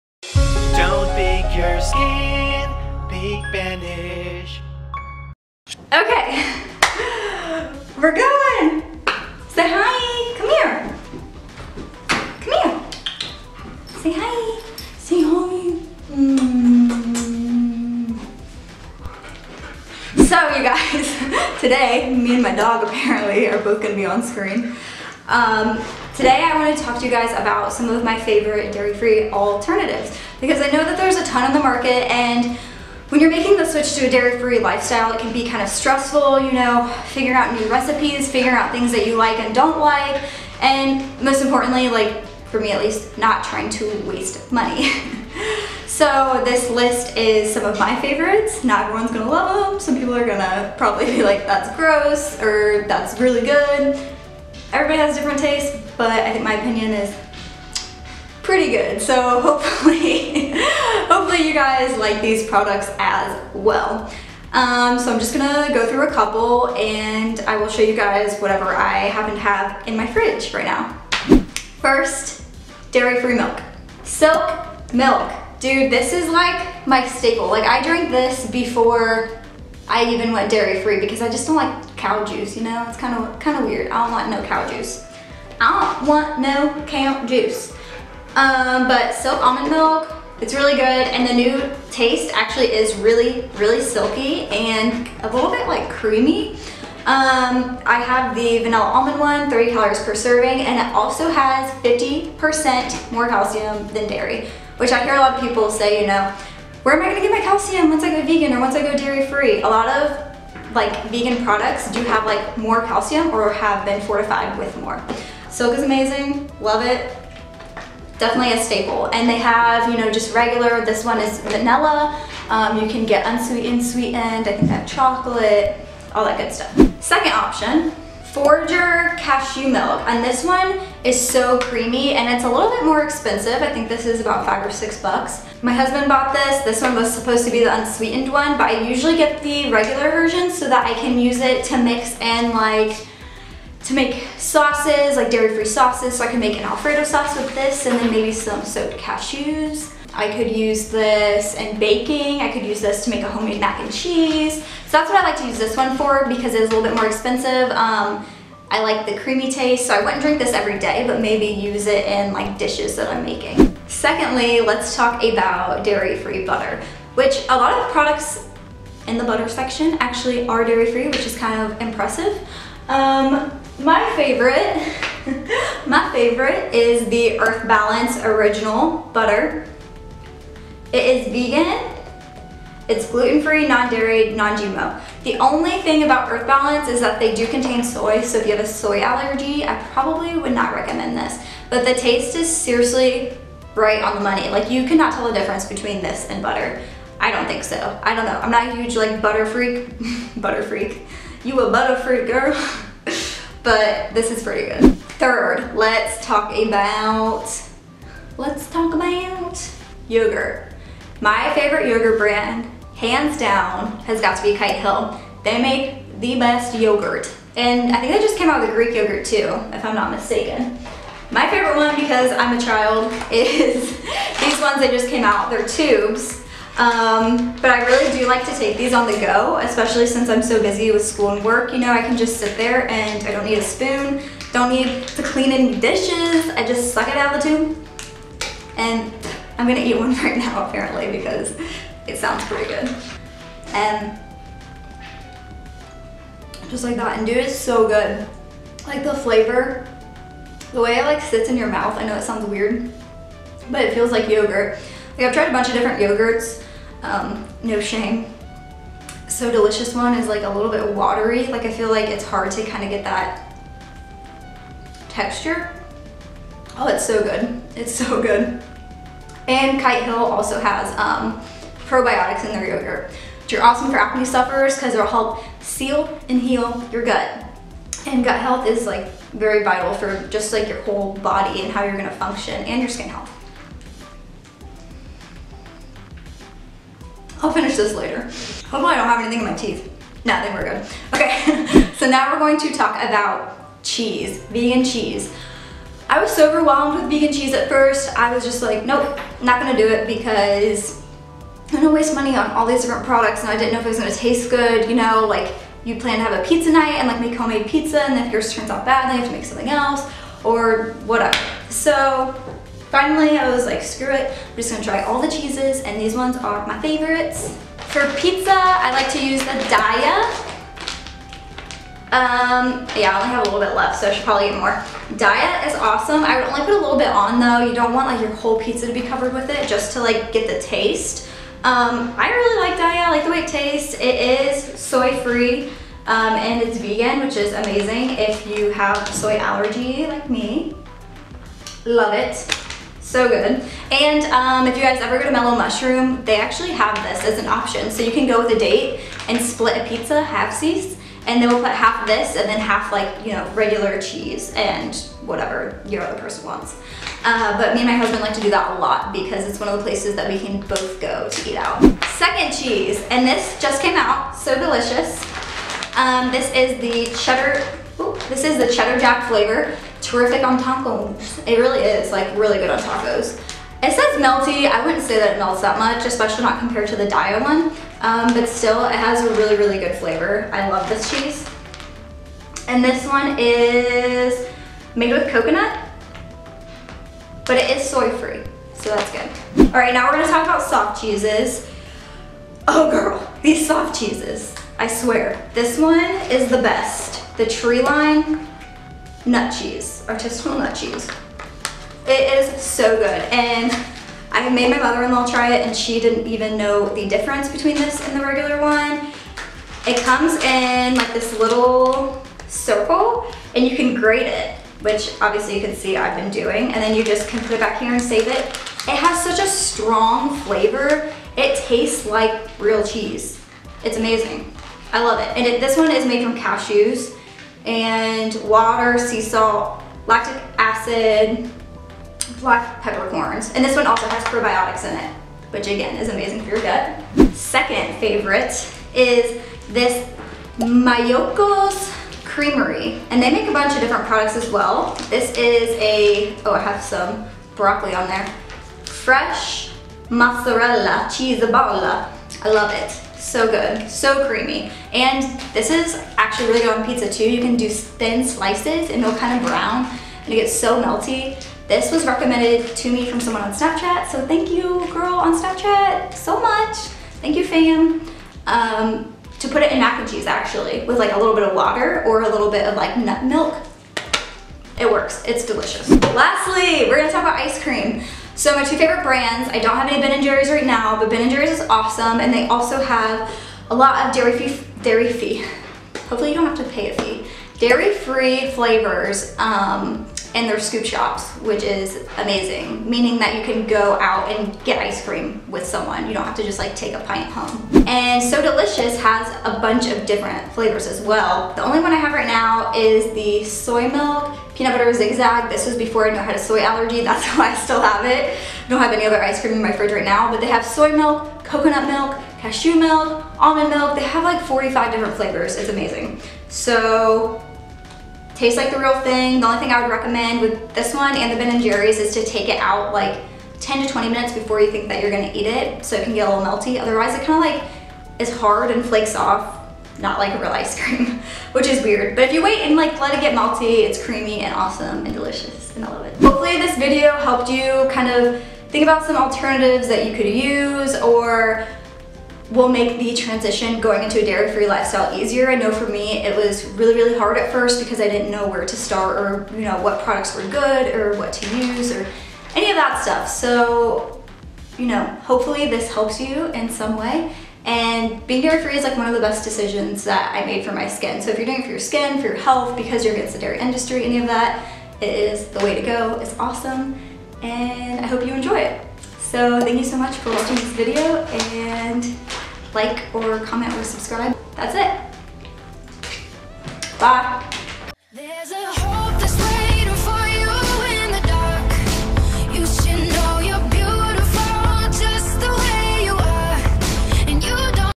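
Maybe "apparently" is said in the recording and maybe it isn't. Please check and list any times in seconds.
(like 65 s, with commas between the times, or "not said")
22 s, 240 s.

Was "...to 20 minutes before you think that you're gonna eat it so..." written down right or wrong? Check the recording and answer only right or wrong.
right.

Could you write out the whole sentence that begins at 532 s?
But if you wait and like let it get malty, it's creamy and awesome and delicious and I love it.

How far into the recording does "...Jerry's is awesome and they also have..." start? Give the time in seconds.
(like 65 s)
481 s.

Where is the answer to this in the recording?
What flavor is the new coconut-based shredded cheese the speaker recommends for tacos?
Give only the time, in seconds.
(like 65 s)
368 s.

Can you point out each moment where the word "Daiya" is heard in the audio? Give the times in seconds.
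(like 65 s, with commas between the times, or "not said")
319 s, 325 s, 332 s, 377 s.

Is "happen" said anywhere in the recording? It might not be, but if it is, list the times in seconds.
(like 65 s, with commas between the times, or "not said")
69 s.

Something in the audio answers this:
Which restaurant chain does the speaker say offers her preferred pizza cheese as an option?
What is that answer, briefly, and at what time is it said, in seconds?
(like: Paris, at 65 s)
Mellow Mushroom, at 345 s.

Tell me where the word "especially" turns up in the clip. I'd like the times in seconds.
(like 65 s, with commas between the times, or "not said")
229 s, 376 s.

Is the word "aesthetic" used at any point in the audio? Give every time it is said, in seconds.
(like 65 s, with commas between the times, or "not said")
not said.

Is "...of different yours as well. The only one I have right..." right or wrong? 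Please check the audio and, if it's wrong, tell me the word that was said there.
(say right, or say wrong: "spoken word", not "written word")
wrong: "flavors", not "yours".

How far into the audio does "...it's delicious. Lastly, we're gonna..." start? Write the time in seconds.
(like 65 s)
475 s.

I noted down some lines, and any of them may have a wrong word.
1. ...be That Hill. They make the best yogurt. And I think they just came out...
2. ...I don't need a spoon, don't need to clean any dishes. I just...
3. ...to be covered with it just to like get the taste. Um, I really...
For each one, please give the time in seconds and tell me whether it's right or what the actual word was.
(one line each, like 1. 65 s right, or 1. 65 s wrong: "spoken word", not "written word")
1. 214 s wrong: "Kite", not "That"
2. 233 s right
3. 328 s right.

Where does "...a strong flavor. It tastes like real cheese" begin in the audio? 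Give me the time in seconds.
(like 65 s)
419 s.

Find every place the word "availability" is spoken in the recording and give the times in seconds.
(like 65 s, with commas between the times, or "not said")
not said.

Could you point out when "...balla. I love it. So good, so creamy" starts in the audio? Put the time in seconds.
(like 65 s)
451 s.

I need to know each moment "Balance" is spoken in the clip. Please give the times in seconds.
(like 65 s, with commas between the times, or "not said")
177 s, 186 s.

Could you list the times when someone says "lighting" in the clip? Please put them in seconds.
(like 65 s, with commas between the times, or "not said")
not said.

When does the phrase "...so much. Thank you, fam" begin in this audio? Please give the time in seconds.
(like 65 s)
466 s.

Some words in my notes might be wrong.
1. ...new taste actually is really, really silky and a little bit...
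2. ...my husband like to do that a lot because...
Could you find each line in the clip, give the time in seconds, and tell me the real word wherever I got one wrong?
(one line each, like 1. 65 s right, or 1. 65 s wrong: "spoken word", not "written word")
1. 91 s right
2. 357 s right.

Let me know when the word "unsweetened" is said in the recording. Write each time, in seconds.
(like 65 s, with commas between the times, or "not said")
123 s, 137 s.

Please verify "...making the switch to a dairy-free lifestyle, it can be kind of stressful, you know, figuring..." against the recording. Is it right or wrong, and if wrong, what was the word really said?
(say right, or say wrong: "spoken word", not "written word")
right.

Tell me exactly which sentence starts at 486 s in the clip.
Hopefully you don't have to pay a fee.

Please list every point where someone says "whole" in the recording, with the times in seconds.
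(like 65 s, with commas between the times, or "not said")
280 s, 328 s.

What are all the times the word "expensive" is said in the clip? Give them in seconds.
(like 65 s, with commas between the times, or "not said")
133 s, 157 s.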